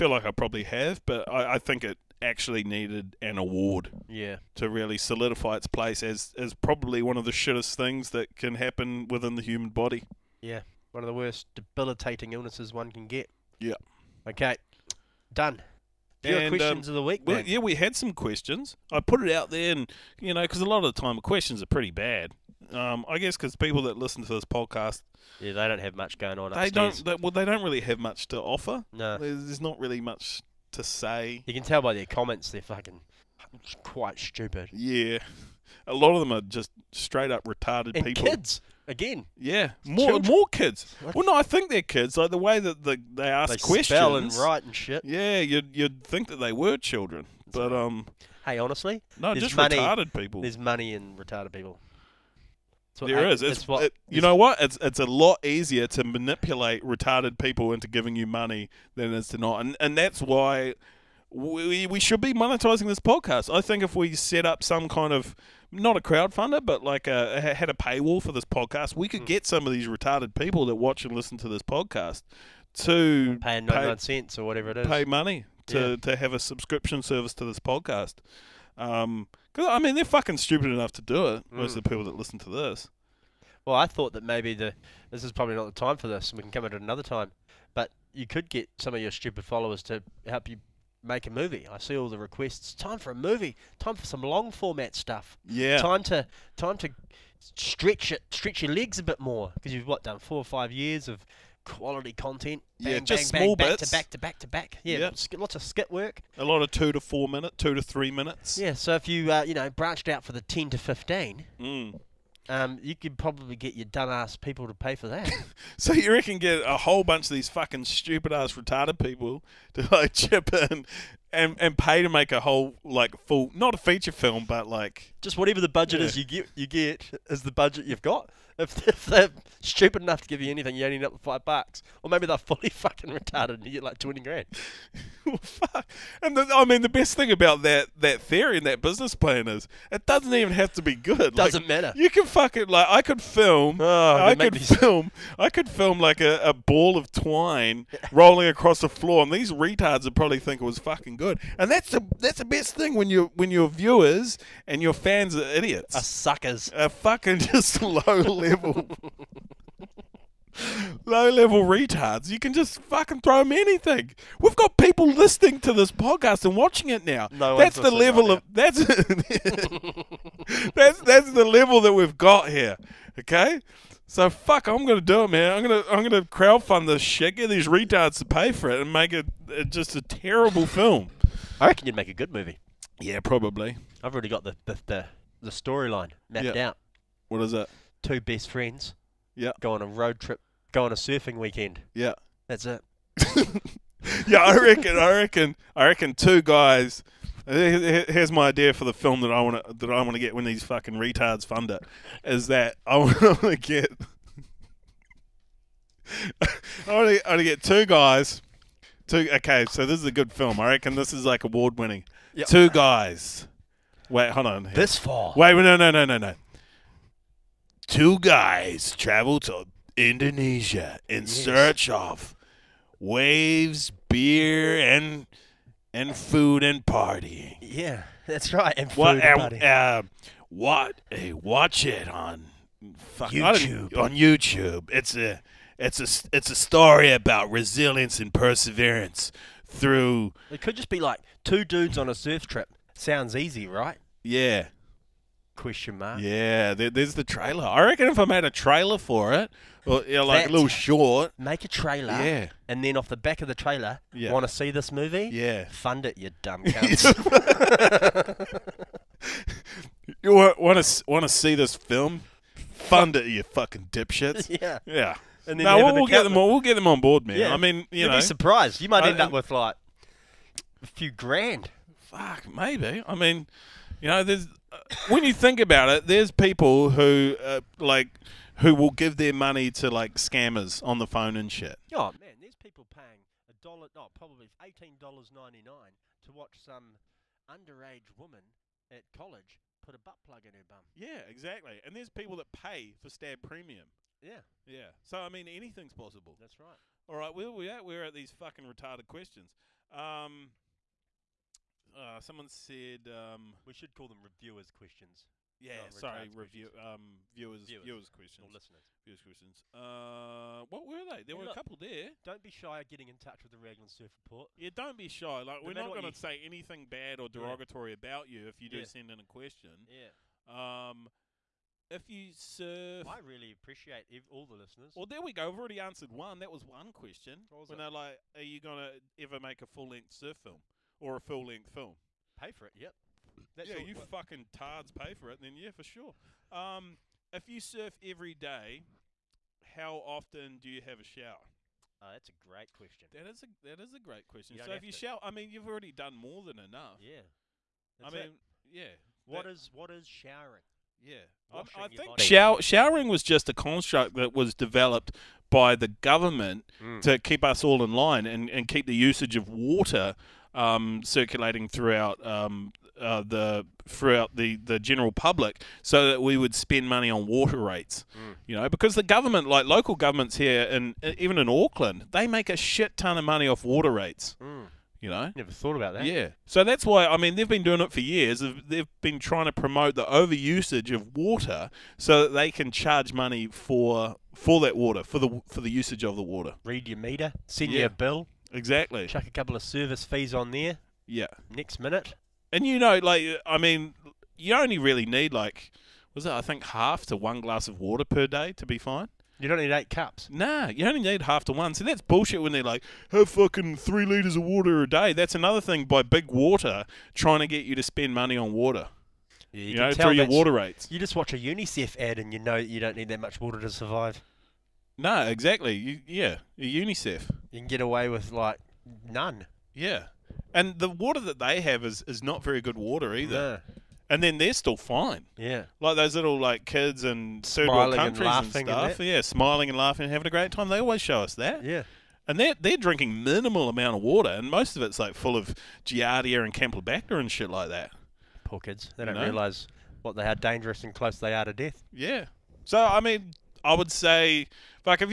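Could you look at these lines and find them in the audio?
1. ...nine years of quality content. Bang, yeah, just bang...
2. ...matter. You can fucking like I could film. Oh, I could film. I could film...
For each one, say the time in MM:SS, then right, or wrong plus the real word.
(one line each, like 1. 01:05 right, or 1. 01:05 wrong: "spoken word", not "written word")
1. 01:40 wrong: "five", not "nine"
2. 02:21 right.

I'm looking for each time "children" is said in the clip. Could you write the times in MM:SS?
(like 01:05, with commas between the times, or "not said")
00:40, 00:46.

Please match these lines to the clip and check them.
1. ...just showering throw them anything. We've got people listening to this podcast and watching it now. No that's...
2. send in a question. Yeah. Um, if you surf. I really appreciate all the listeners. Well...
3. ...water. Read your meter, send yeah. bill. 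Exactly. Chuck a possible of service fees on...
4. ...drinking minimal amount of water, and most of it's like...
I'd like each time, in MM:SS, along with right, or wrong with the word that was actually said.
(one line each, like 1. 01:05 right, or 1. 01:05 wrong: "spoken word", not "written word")
1. 02:42 wrong: "fucking", not "showering"
2. 05:18 right
3. 06:26 wrong: "couple", not "possible"
4. 07:12 right.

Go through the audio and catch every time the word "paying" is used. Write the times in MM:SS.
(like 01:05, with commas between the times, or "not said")
04:42.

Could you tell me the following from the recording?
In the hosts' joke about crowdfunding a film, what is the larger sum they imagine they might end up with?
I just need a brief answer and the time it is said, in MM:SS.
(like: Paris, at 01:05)
20 grand, at 02:13.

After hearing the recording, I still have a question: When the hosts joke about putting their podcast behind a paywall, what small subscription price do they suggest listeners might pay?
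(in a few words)
99 cents.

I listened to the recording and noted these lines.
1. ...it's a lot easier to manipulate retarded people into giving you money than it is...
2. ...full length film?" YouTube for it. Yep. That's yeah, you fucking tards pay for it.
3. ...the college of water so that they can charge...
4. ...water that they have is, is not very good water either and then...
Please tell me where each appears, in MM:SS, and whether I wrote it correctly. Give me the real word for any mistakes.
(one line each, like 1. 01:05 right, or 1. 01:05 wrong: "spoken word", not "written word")
1. 00:54 right
2. 05:31 wrong: "Pay", not "YouTube"
3. 06:19 wrong: "overusage", not "college"
4. 07:00 right.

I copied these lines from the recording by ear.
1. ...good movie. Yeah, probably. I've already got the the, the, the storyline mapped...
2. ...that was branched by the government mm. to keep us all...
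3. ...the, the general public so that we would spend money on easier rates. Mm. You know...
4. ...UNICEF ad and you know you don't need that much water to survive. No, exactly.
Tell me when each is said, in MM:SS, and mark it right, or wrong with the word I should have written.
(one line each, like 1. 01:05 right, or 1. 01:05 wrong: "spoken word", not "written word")
1. 03:02 right
2. 05:54 wrong: "developed", not "branched"
3. 06:04 wrong: "water", not "easier"
4. 06:51 right.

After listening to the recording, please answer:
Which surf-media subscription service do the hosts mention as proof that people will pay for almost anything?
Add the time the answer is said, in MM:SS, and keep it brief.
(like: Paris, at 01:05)
Stab Premium, at 04:53.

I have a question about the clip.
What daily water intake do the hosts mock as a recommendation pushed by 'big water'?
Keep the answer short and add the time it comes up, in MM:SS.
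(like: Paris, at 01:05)
3 litres, at 06:43.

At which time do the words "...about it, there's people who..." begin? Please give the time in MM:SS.
04:35.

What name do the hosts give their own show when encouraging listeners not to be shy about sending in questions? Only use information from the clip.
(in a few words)
Raglan Surf Report.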